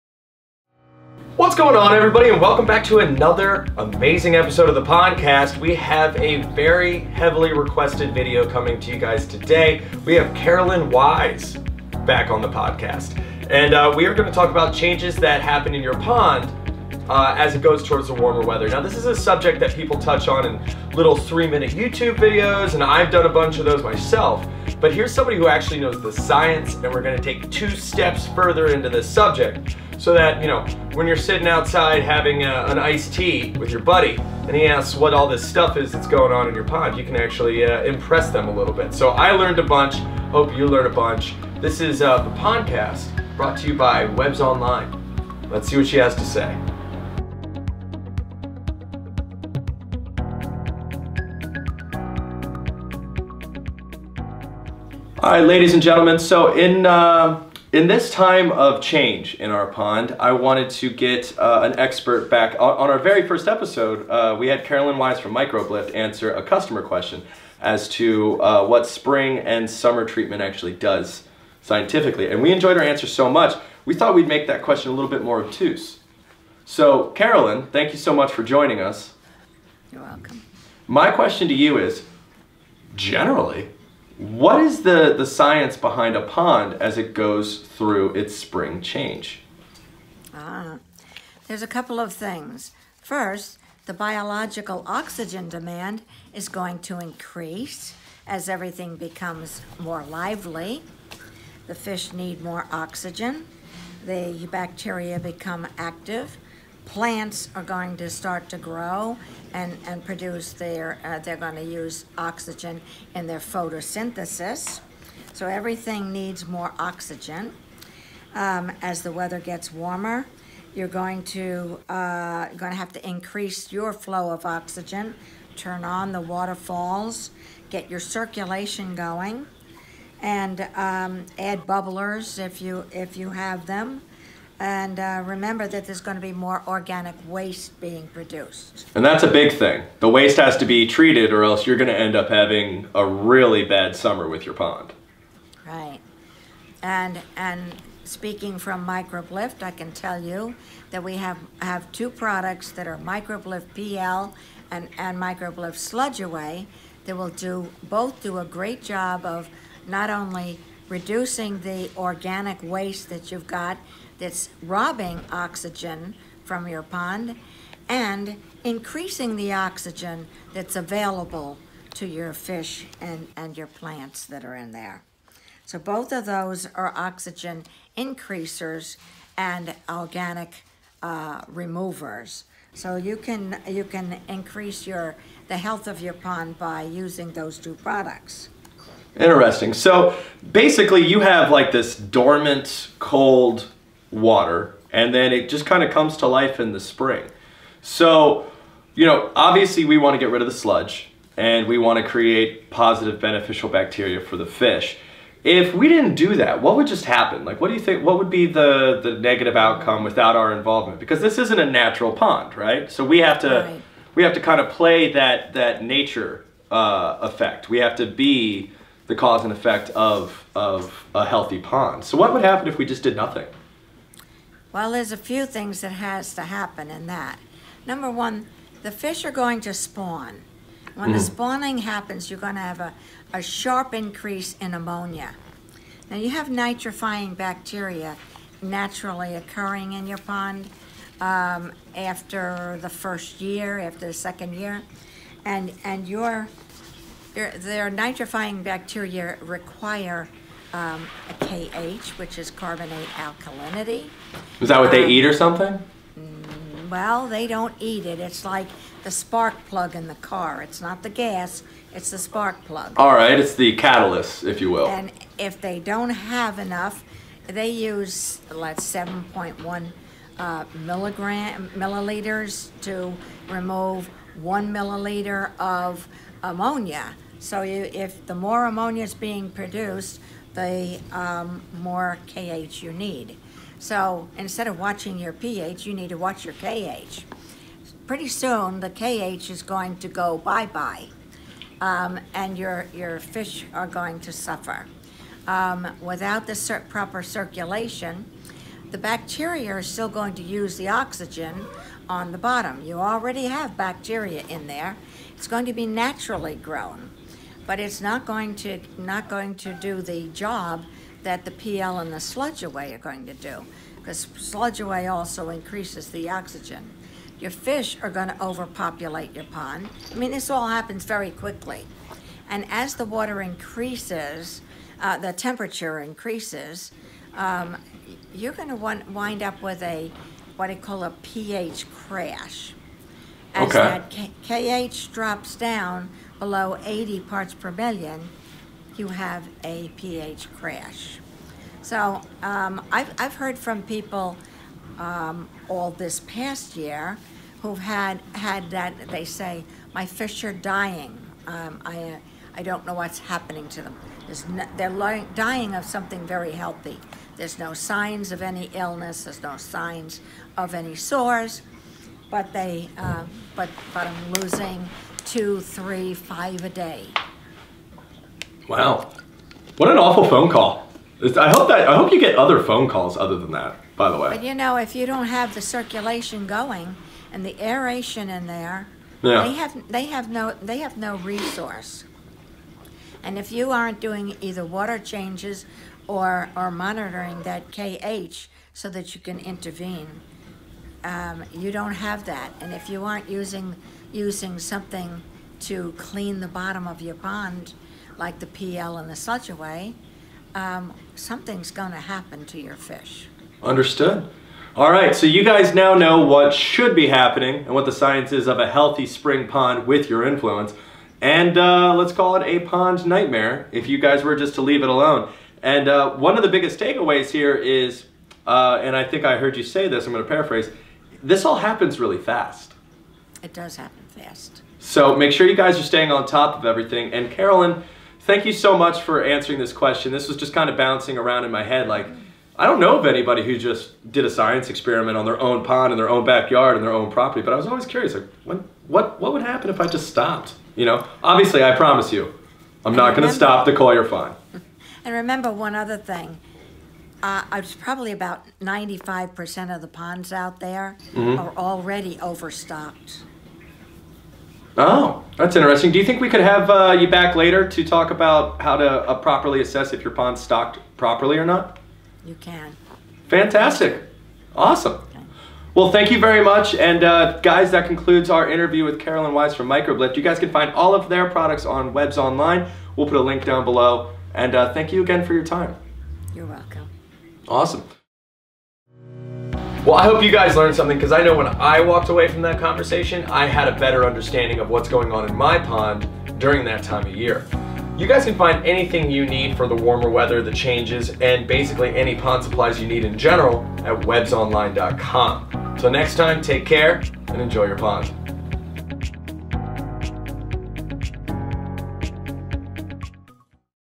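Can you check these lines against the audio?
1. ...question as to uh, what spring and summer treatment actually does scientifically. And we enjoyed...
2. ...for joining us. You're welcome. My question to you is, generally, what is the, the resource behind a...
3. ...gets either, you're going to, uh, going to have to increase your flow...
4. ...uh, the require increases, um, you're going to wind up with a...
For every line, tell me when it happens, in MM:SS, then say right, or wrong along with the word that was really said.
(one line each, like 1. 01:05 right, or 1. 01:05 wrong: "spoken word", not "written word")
1. 01:06 right
2. 01:18 wrong: "science", not "resource"
3. 01:59 wrong: "warmer", not "either"
4. 05:25 wrong: "temperature", not "require".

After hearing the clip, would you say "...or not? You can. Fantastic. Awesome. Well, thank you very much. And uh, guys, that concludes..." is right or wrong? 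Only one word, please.
right.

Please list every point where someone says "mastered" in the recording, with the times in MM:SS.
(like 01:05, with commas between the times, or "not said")
not said.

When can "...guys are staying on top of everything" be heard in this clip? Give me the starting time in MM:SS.
07:05.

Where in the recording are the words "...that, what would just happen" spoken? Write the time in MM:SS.
03:26.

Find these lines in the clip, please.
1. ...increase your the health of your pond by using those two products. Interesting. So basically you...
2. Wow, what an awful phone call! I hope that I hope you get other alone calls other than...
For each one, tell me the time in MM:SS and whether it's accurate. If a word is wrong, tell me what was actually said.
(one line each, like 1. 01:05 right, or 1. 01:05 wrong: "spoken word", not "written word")
1. 03:04 right
2. 06:08 wrong: "phone", not "alone".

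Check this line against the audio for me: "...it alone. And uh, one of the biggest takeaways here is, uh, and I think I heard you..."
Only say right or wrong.
right.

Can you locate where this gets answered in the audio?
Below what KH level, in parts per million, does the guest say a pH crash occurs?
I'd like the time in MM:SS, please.
05:36.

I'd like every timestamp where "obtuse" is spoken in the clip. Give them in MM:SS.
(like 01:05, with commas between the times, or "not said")
01:15.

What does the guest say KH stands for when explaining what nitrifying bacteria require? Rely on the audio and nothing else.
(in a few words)
carbonate alkalinity.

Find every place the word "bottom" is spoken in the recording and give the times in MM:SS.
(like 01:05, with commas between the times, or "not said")
05:02, 06:36.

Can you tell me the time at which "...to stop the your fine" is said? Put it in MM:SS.
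07:23.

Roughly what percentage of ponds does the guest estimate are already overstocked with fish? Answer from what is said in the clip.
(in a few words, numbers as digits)
95%.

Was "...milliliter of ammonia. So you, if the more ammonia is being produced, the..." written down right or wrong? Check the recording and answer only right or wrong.
right.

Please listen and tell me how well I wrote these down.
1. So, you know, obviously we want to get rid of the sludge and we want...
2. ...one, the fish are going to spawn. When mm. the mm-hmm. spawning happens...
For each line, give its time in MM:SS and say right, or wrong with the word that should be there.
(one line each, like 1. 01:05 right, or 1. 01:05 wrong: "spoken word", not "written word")
1. 03:17 right
2. 03:48 right.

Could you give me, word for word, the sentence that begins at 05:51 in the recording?
Um, I, I don't know what's happening to them.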